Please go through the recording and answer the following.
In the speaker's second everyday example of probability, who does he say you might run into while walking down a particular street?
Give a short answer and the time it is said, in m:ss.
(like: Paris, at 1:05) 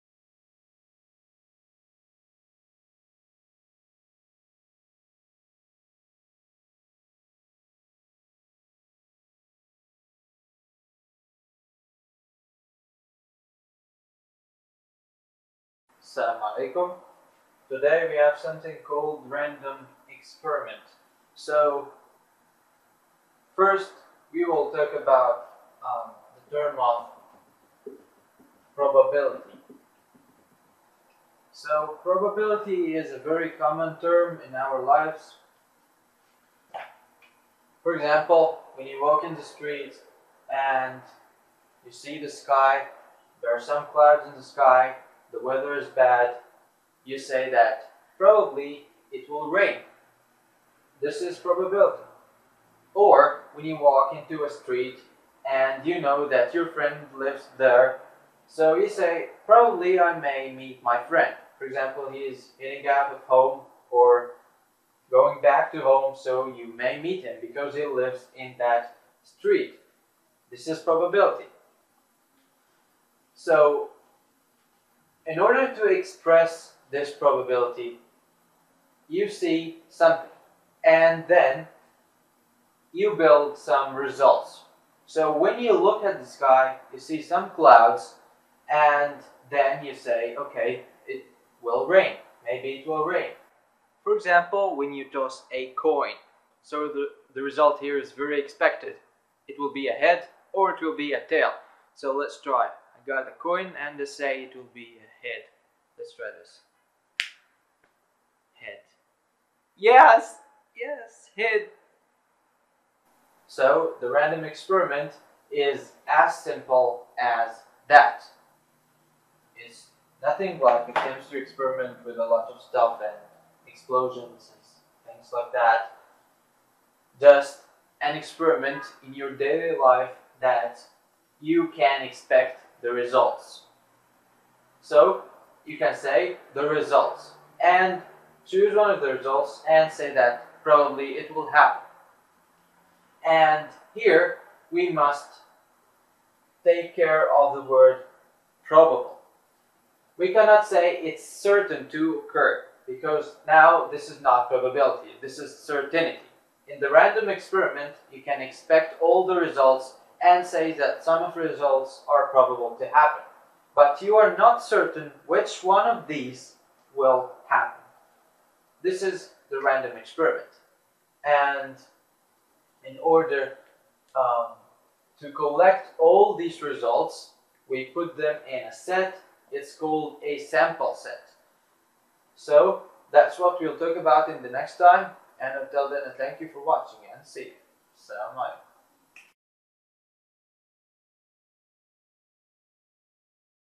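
my friend, at 1:00.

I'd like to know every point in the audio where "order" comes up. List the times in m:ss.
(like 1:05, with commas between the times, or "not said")
1:15, 2:53.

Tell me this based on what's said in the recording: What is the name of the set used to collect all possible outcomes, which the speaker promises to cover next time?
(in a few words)
sample set.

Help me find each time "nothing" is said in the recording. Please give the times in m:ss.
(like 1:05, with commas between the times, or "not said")
2:00.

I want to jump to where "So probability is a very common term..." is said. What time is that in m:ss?
0:31.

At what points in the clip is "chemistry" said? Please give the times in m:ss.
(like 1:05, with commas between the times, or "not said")
2:00.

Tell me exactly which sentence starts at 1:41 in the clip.
So let's try got a coin and they say it will be a head.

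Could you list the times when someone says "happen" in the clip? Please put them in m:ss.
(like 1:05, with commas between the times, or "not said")
2:21, 2:42, 2:47.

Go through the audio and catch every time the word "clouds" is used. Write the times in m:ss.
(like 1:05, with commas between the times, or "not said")
0:43, 1:27.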